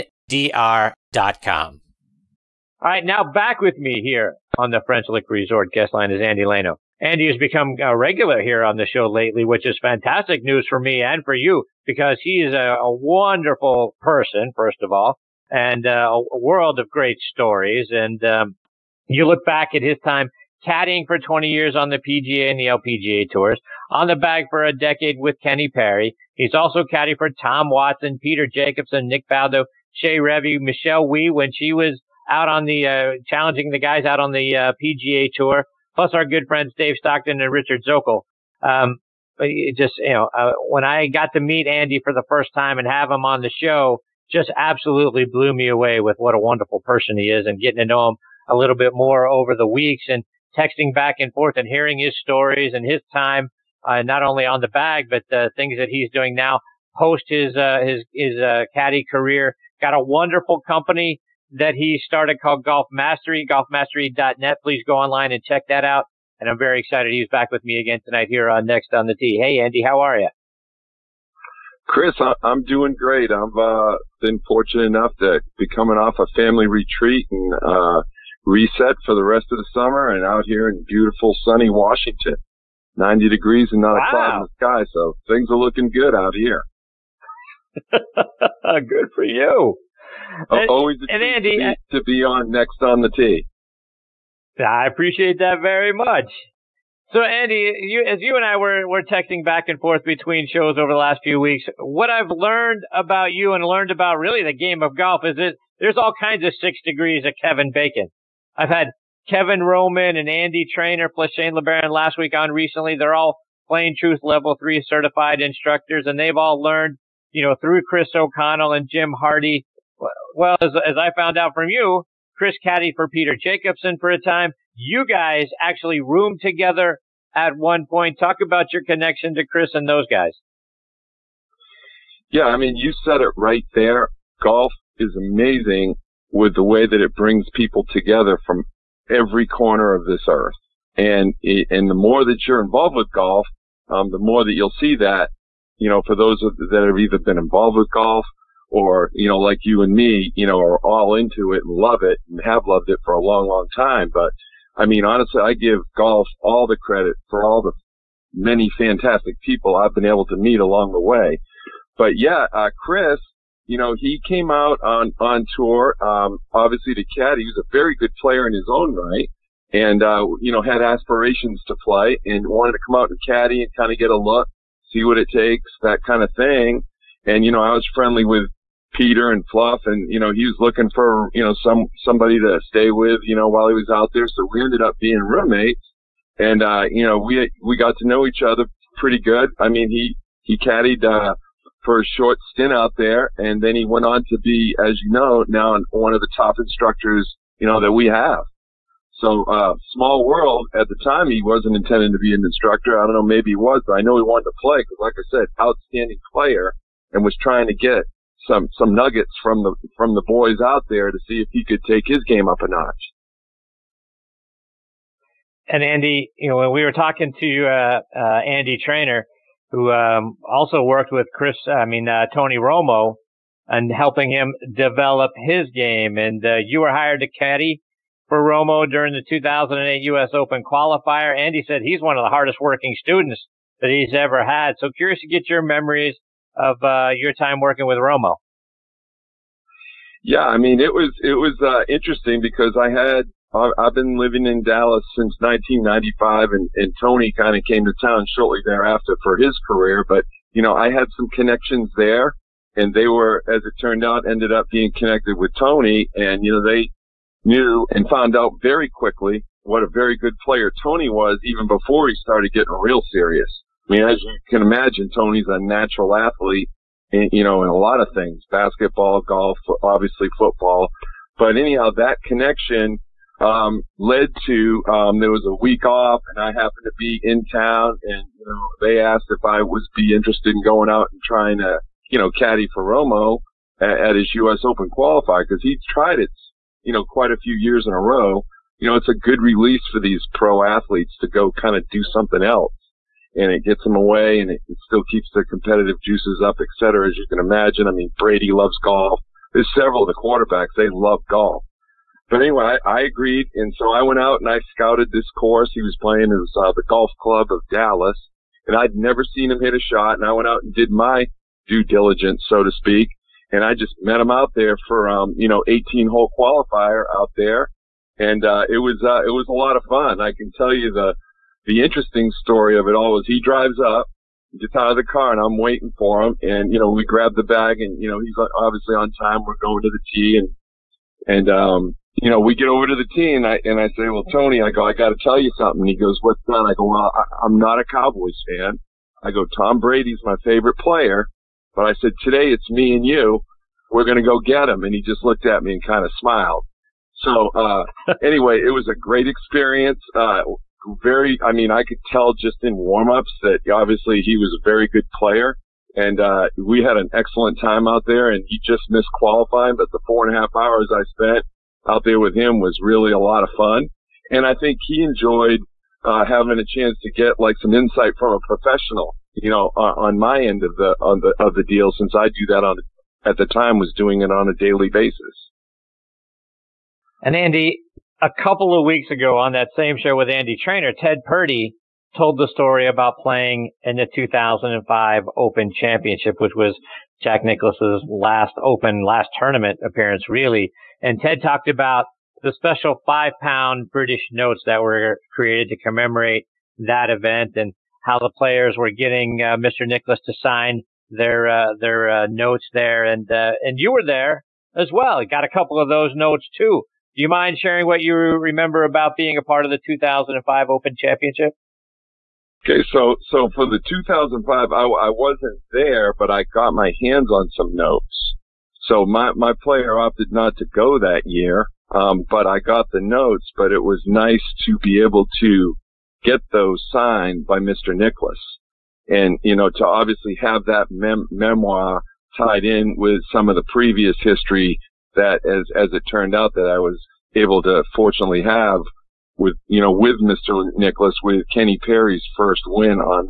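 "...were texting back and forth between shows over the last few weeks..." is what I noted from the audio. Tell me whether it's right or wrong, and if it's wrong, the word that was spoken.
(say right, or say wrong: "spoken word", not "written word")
right.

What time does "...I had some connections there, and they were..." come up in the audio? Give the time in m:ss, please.
4:10.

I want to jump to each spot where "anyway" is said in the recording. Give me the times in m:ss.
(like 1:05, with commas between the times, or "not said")
5:02, 5:48.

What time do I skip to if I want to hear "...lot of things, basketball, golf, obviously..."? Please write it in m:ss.
4:27.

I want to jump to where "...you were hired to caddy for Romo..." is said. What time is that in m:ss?
3:46.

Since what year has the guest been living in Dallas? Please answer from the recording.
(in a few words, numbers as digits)
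1995.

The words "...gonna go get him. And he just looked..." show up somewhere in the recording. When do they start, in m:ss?
5:44.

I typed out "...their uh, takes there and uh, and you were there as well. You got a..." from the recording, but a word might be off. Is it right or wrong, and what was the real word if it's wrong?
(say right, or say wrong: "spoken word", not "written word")
wrong: "notes", not "takes".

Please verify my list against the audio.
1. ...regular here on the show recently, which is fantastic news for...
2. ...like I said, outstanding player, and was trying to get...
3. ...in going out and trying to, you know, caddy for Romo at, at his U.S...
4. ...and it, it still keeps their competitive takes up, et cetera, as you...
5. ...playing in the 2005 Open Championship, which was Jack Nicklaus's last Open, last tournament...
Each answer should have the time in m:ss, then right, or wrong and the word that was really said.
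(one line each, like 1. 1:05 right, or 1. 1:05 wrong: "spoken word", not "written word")
1. 0:07 wrong: "lately", not "recently"
2. 3:24 right
3. 4:40 right
4. 4:54 wrong: "juices", not "takes"
5. 6:23 right.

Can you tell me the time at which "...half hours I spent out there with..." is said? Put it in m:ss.
6:00.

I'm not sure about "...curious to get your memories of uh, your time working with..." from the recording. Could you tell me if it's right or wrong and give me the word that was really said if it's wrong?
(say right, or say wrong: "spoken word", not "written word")
right.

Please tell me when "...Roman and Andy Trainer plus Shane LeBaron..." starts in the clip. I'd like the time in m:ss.
1:49.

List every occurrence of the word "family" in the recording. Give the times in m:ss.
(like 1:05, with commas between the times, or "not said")
1:16.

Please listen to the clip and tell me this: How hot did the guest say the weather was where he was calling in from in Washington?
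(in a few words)
90 degrees.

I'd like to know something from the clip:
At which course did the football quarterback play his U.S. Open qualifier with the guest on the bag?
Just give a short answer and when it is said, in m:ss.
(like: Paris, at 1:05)
Golf Club of Dallas, at 5:06.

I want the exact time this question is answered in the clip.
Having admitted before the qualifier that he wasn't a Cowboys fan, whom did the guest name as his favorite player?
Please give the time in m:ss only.
5:39.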